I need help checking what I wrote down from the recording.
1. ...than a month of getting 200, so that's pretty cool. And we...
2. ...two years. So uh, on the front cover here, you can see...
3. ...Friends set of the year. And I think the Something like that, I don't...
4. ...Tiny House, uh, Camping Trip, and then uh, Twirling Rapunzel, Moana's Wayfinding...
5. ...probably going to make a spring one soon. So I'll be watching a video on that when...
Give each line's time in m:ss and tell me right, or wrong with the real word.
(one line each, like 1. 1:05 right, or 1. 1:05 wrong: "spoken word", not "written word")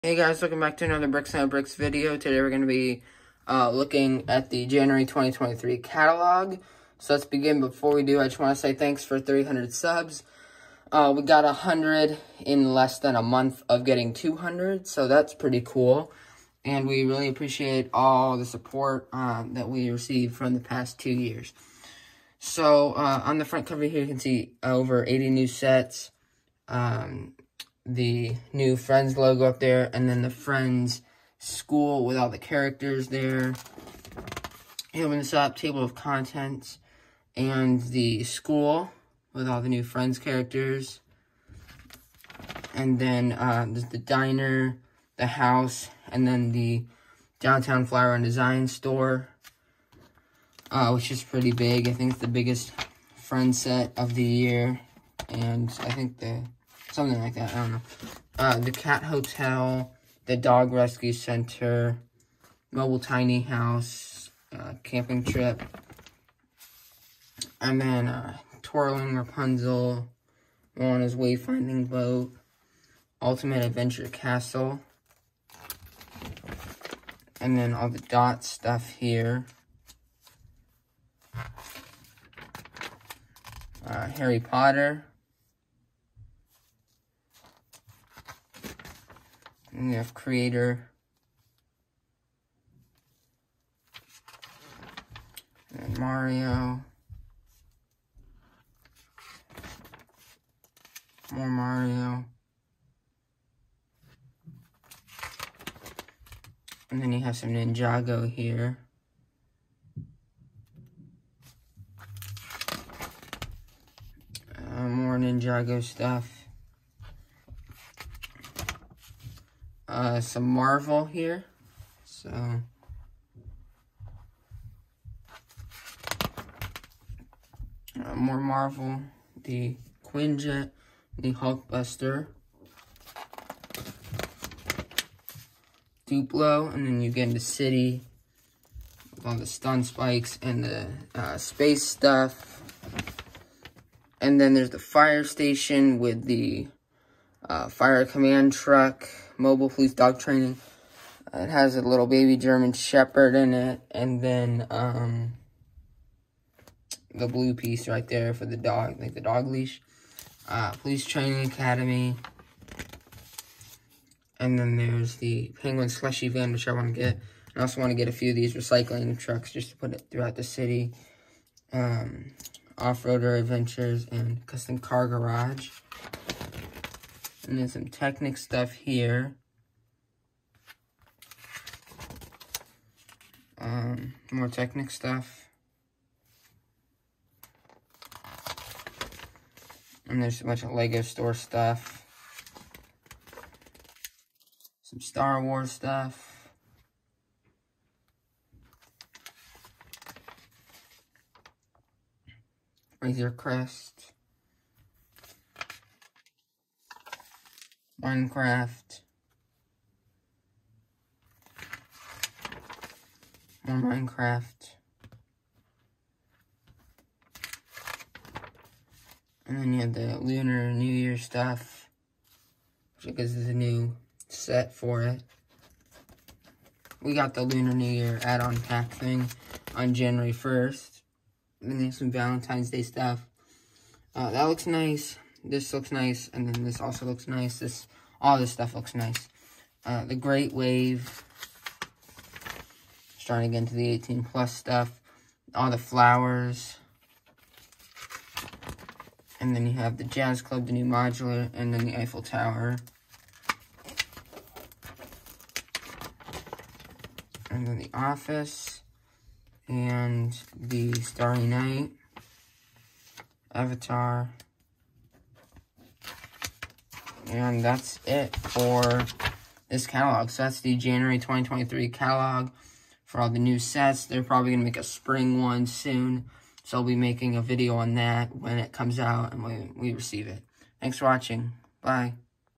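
1. 0:12 right
2. 0:20 right
3. 0:53 right
4. 1:02 right
5. 4:34 wrong: "making", not "watching".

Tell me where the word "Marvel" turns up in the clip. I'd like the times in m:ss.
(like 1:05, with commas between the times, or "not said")
2:00, 2:08.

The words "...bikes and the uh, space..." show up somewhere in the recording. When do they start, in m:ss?
2:19.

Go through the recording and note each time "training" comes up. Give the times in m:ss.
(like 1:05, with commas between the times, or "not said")
2:30, 2:41.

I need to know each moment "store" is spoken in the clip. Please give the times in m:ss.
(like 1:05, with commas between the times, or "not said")
0:48, 3:11.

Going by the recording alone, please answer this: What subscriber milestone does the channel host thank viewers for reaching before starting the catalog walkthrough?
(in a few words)
300.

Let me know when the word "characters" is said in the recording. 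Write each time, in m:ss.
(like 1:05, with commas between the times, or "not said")
0:32, 0:40.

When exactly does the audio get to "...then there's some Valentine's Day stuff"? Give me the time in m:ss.
3:51.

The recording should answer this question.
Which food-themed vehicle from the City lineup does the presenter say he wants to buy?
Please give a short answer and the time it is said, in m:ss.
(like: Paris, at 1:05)
Penguin Slushy van, at 2:45.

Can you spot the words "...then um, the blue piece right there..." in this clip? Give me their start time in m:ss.
2:34.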